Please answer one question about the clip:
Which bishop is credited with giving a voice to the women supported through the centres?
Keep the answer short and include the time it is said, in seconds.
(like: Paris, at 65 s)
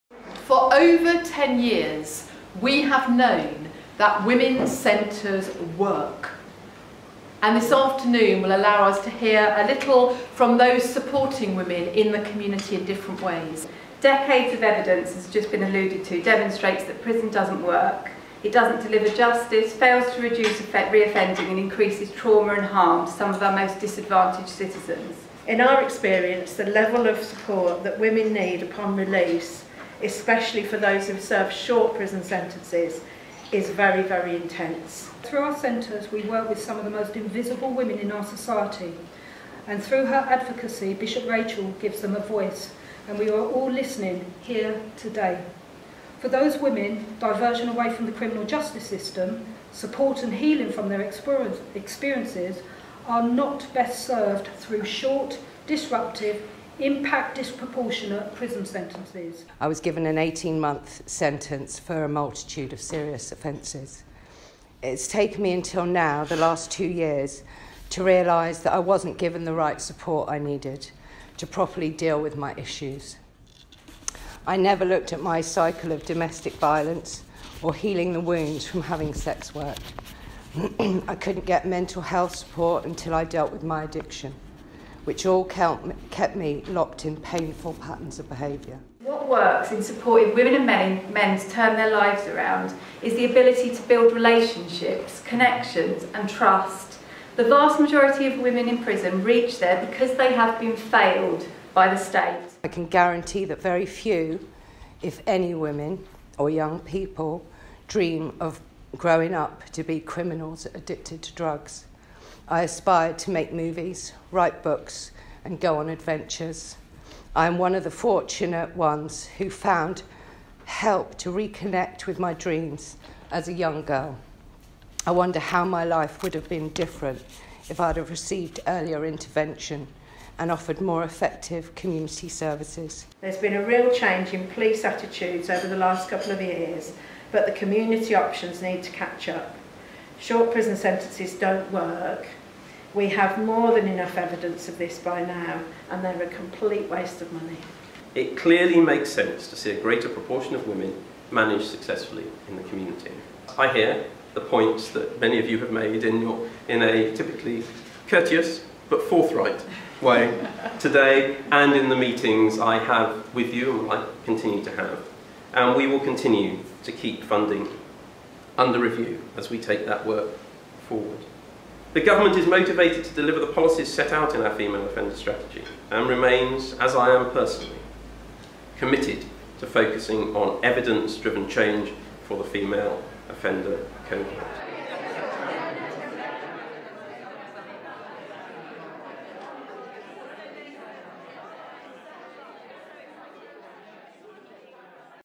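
Bishop Rachel, at 40 s.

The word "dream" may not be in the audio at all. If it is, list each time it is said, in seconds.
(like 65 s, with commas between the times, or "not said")
107 s, 122 s.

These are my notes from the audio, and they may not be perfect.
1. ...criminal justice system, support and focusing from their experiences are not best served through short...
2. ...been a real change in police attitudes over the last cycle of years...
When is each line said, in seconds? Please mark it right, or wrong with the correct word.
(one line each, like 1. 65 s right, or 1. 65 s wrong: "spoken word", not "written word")
1. 48 s wrong: "healing", not "focusing"
2. 133 s wrong: "couple", not "cycle".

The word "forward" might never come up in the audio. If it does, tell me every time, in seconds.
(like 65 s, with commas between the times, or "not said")
170 s.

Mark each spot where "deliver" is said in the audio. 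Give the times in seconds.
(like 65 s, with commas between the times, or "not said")
18 s, 173 s.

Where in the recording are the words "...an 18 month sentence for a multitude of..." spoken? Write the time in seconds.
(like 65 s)
60 s.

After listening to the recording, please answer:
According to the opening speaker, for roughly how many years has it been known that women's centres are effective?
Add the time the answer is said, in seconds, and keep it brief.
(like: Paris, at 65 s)
Over 10 years, at 0 s.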